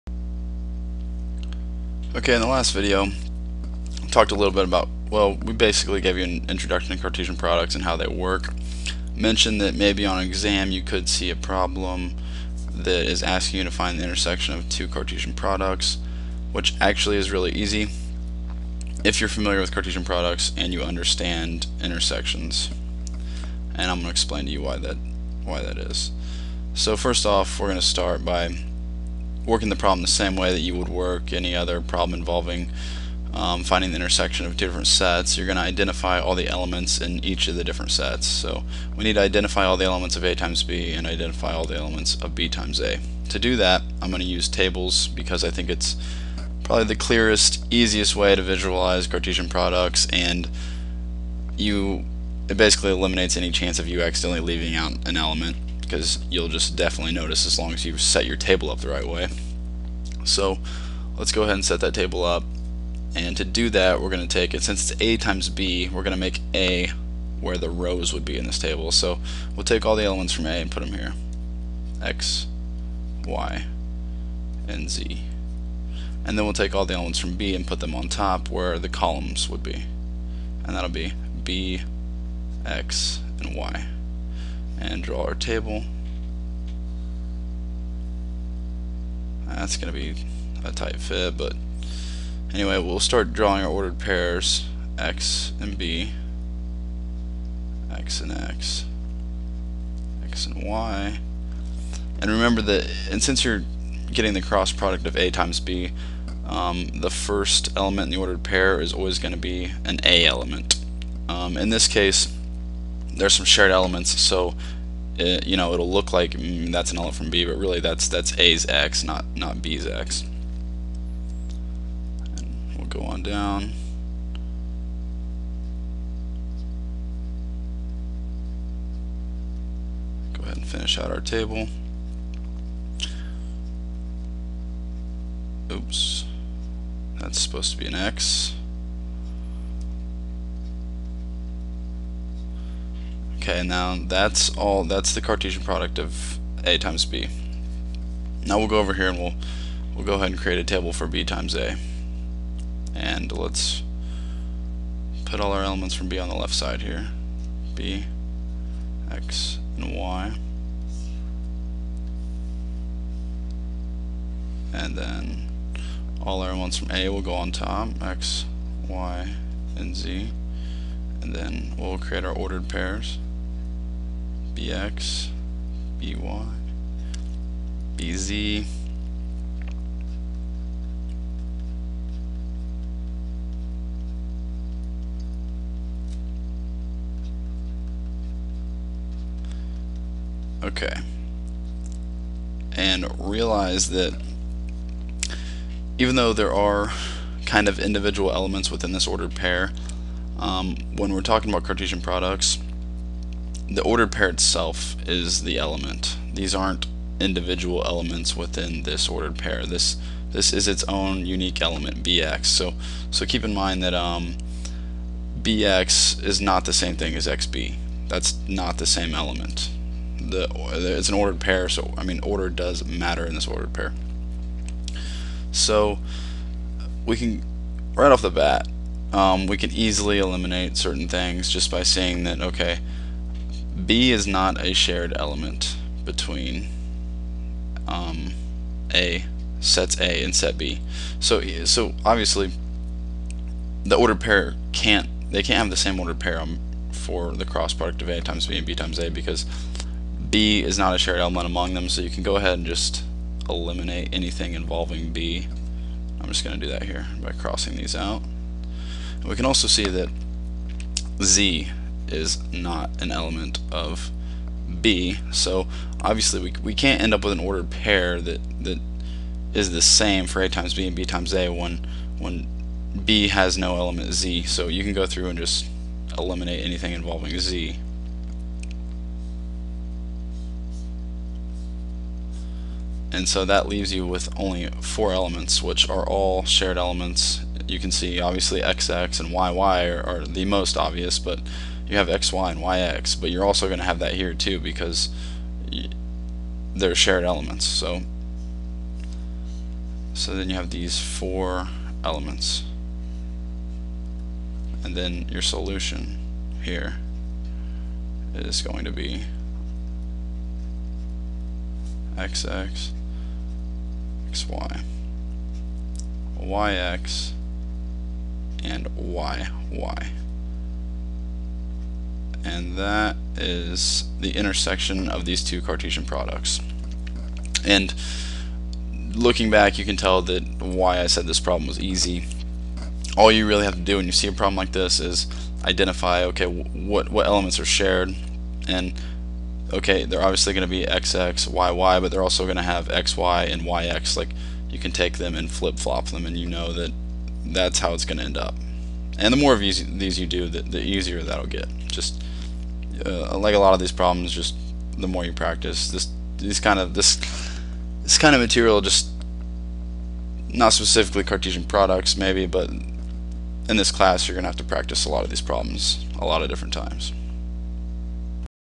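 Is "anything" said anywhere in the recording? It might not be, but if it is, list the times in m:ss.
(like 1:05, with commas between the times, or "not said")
4:14, 4:36.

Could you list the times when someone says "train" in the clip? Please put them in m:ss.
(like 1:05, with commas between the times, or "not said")
not said.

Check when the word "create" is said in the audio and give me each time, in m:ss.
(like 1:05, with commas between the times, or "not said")
2:30, 2:51.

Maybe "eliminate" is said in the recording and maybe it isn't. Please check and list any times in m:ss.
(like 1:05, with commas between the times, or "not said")
0:52, 3:50, 4:13, 4:36.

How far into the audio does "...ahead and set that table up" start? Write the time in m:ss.
1:01.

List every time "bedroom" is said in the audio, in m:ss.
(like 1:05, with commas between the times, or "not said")
not said.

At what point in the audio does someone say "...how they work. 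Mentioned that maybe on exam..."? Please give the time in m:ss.
0:07.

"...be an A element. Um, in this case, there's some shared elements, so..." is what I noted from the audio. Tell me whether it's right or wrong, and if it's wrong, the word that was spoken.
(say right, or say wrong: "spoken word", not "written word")
right.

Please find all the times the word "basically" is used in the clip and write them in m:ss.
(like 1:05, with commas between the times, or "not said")
0:05, 0:52.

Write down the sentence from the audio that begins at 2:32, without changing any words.
And let's put all our elements from B on the left side here.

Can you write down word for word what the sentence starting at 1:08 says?
So we'll take all the elements from A and put them here.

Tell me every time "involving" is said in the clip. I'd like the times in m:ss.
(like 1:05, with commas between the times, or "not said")
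0:32, 4:14, 4:36.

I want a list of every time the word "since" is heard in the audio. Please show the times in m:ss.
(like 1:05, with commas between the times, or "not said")
1:04, 1:43.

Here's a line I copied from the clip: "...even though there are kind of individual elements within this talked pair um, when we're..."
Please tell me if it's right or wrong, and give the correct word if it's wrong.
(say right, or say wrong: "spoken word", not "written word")
wrong: "ordered", not "talked".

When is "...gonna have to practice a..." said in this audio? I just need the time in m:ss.
6:04.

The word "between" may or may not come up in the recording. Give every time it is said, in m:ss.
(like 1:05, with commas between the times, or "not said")
3:56.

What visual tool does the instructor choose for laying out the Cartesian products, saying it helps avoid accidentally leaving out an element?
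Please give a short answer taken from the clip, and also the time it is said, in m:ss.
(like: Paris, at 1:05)
Tables, at 0:44.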